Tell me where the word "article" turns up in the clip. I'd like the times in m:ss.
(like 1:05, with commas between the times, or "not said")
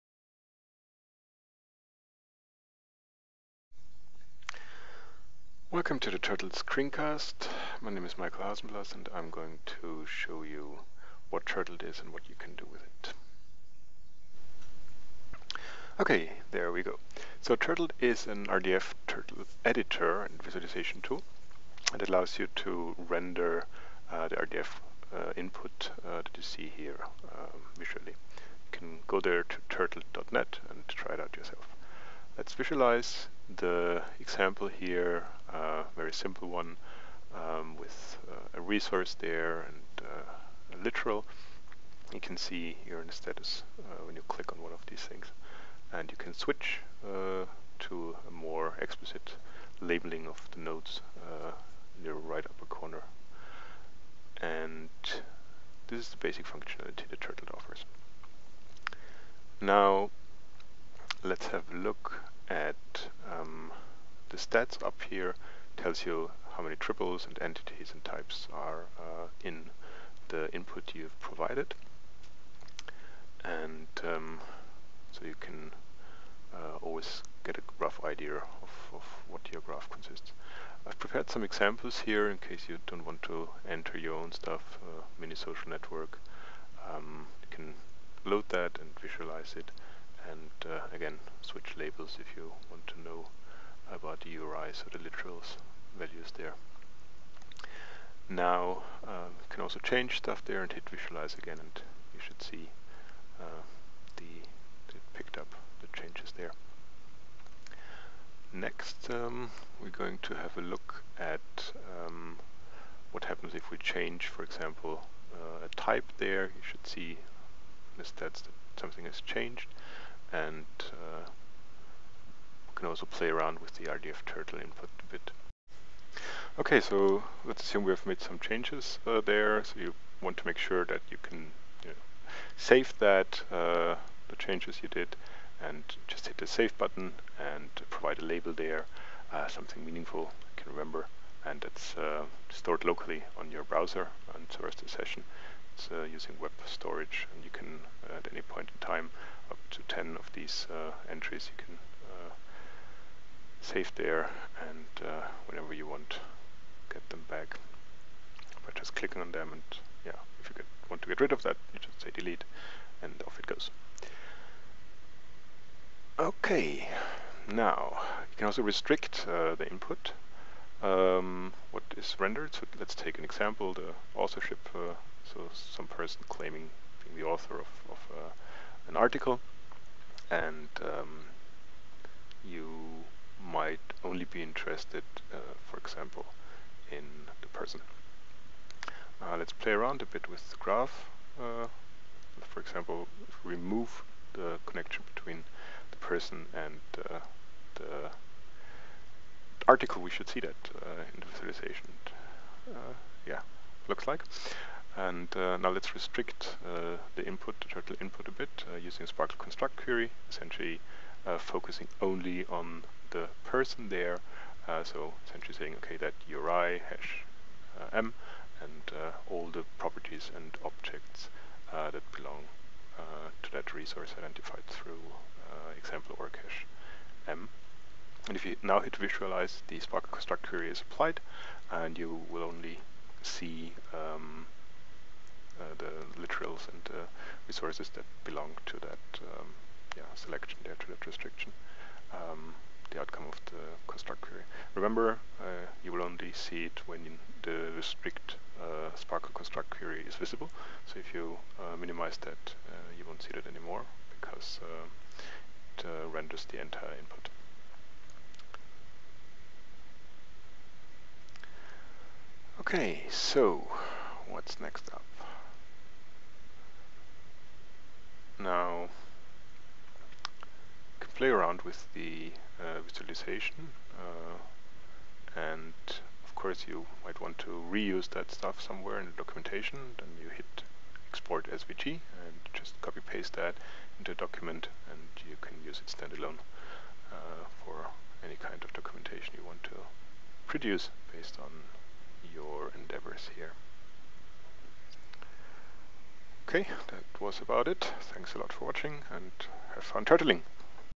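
2:58, 3:19.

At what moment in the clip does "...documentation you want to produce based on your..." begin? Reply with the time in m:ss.
4:48.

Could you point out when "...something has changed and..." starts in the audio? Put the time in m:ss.
1:58.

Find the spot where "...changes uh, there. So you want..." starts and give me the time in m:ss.
2:08.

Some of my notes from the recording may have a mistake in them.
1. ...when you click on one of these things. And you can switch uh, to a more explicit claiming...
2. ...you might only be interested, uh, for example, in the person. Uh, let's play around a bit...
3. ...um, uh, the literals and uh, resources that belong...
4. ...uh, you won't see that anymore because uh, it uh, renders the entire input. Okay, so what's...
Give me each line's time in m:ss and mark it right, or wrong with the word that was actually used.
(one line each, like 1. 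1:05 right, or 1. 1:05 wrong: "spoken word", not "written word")
1. 0:44 wrong: "labeling", not "claiming"
2. 3:02 right
3. 3:53 right
4. 4:12 right.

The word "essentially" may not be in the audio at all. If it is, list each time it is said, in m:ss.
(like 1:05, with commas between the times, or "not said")
3:30, 3:35.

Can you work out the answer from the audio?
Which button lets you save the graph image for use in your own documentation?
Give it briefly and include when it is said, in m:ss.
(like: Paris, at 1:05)
Export SVG, at 4:41.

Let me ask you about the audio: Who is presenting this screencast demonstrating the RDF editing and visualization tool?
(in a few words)
Michael Hausenblas.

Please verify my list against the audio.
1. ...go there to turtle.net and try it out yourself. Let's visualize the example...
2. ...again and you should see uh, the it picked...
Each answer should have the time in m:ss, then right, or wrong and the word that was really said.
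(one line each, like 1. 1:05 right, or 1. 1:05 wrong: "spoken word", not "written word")
1. 0:29 right
2. 1:41 right.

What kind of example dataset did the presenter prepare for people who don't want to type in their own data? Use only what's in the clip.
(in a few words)
Mini social network.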